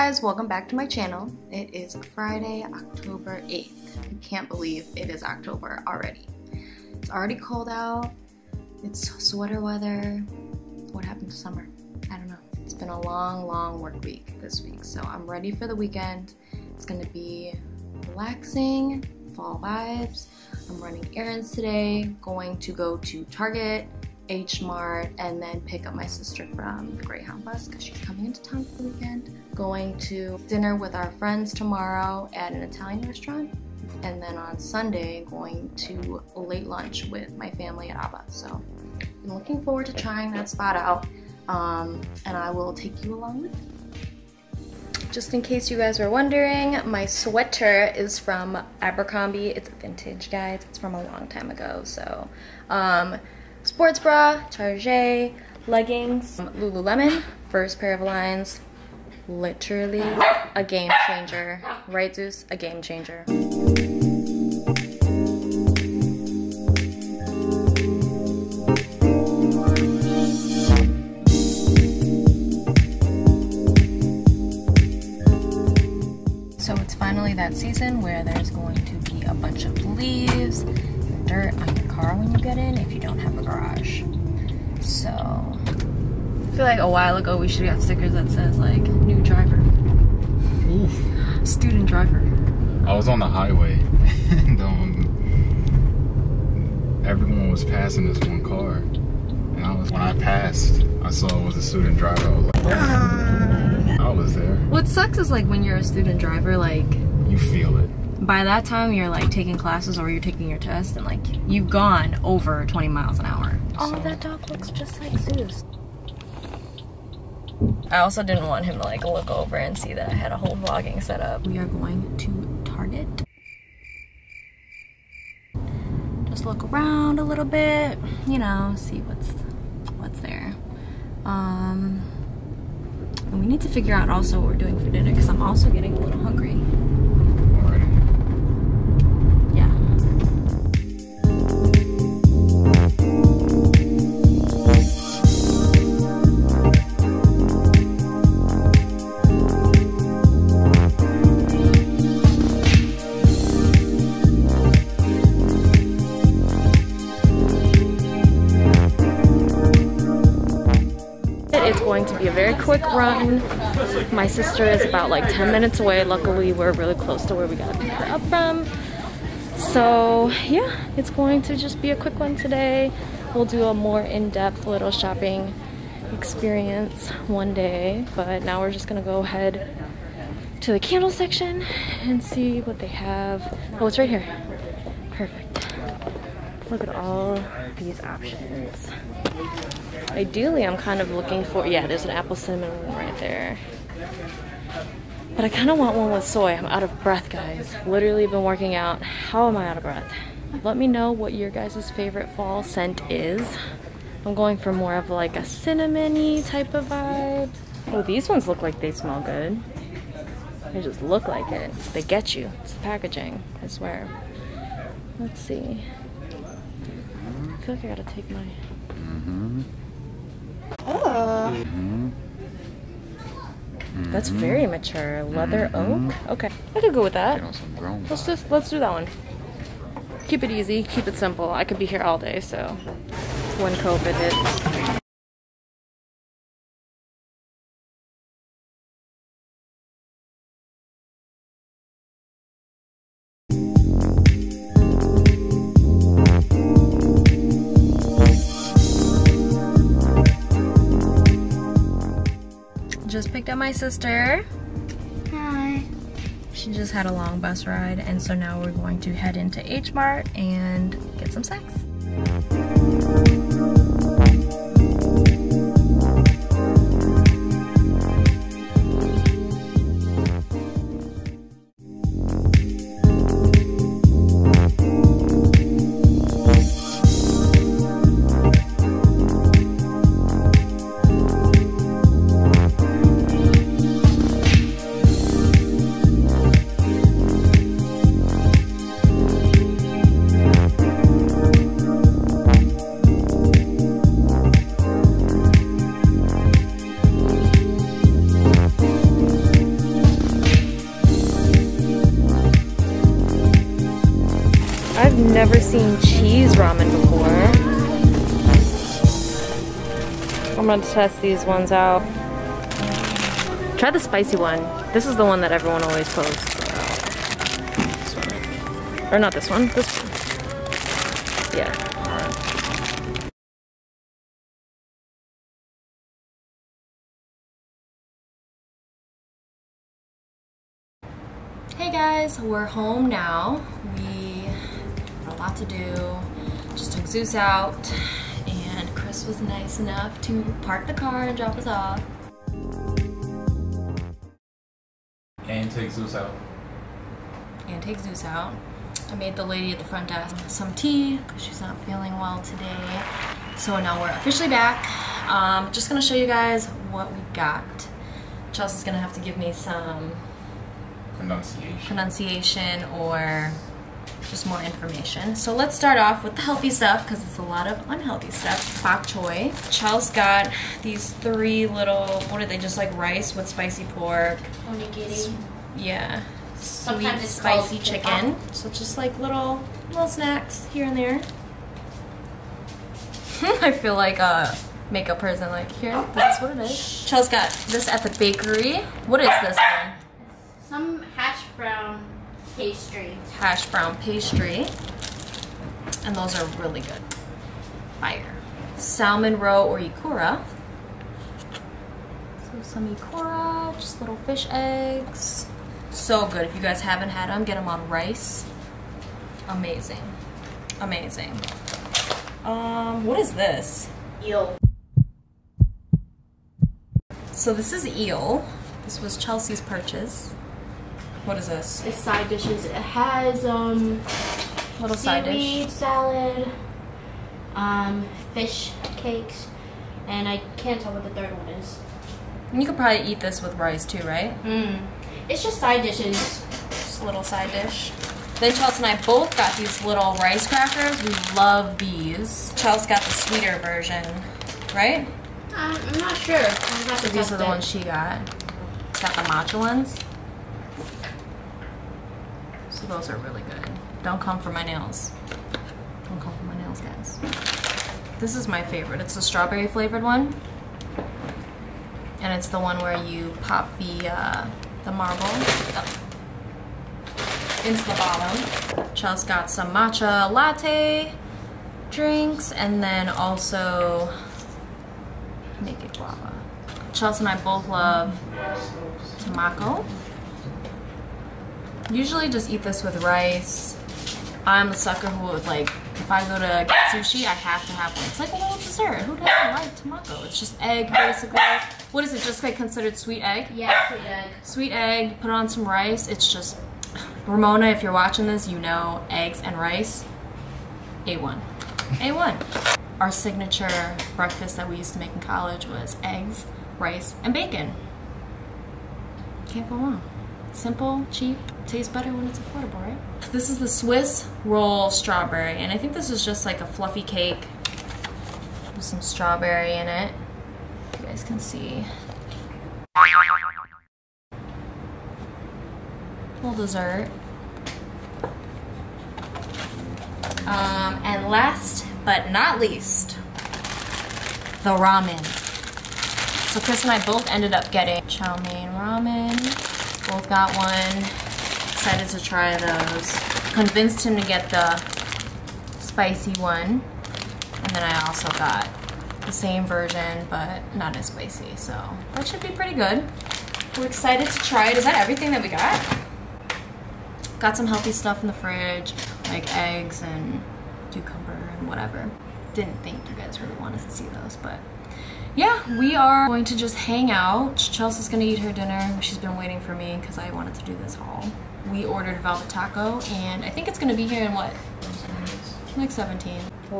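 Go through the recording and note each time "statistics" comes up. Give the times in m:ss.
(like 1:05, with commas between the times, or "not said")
not said.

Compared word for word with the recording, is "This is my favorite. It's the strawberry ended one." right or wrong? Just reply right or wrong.
wrong.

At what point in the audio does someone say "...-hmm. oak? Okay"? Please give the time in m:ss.
3:45.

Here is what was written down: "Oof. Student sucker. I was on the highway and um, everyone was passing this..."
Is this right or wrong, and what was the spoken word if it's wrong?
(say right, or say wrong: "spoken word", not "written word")
wrong: "driver", not "sucker".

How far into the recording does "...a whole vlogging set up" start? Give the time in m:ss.
2:00.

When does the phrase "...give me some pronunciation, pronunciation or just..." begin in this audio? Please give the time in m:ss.
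5:59.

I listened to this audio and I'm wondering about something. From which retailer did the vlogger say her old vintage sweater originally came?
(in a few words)
Abercrombie.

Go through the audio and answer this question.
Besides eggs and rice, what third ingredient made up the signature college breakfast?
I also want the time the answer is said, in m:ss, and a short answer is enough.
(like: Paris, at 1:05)
Bacon, at 8:27.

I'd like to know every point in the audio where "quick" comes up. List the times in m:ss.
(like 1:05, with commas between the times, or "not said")
2:42, 2:51.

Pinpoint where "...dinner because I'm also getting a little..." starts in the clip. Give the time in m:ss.
2:14.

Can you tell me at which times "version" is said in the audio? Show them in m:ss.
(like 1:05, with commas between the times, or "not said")
7:23, 9:09.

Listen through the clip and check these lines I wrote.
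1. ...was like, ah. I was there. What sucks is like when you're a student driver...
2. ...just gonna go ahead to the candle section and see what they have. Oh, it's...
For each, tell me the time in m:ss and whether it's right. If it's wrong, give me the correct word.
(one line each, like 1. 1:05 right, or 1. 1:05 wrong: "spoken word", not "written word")
1. 1:42 right
2. 2:58 right.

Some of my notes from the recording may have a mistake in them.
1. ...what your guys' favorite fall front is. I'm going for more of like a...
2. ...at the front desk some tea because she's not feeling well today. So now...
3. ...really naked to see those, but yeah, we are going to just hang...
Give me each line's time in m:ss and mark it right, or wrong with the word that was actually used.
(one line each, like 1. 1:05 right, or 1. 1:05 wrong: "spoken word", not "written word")
1. 3:21 wrong: "scent", not "front"
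2. 5:49 right
3. 9:23 wrong: "wanted", not "naked".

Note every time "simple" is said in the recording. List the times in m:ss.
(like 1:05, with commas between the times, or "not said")
3:51, 8:30.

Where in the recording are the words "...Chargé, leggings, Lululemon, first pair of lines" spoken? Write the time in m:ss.
0:54.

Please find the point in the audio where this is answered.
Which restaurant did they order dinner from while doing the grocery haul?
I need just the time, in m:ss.
9:32.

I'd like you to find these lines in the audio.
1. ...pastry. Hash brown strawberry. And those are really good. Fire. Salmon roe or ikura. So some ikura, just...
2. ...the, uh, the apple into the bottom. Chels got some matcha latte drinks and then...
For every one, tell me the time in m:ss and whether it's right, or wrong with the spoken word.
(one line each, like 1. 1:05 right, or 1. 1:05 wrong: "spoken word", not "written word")
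1. 6:32 wrong: "pastry", not "strawberry"
2. 7:43 wrong: "marble", not "apple".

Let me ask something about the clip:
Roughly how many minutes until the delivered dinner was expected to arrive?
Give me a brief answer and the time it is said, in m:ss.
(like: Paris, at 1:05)
17, at 9:35.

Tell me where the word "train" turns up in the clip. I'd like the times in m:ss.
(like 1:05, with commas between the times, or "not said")
not said.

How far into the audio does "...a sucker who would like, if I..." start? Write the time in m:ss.
8:04.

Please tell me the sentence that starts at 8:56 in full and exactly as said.
So Chris and I both ended up getting chow mein ramen.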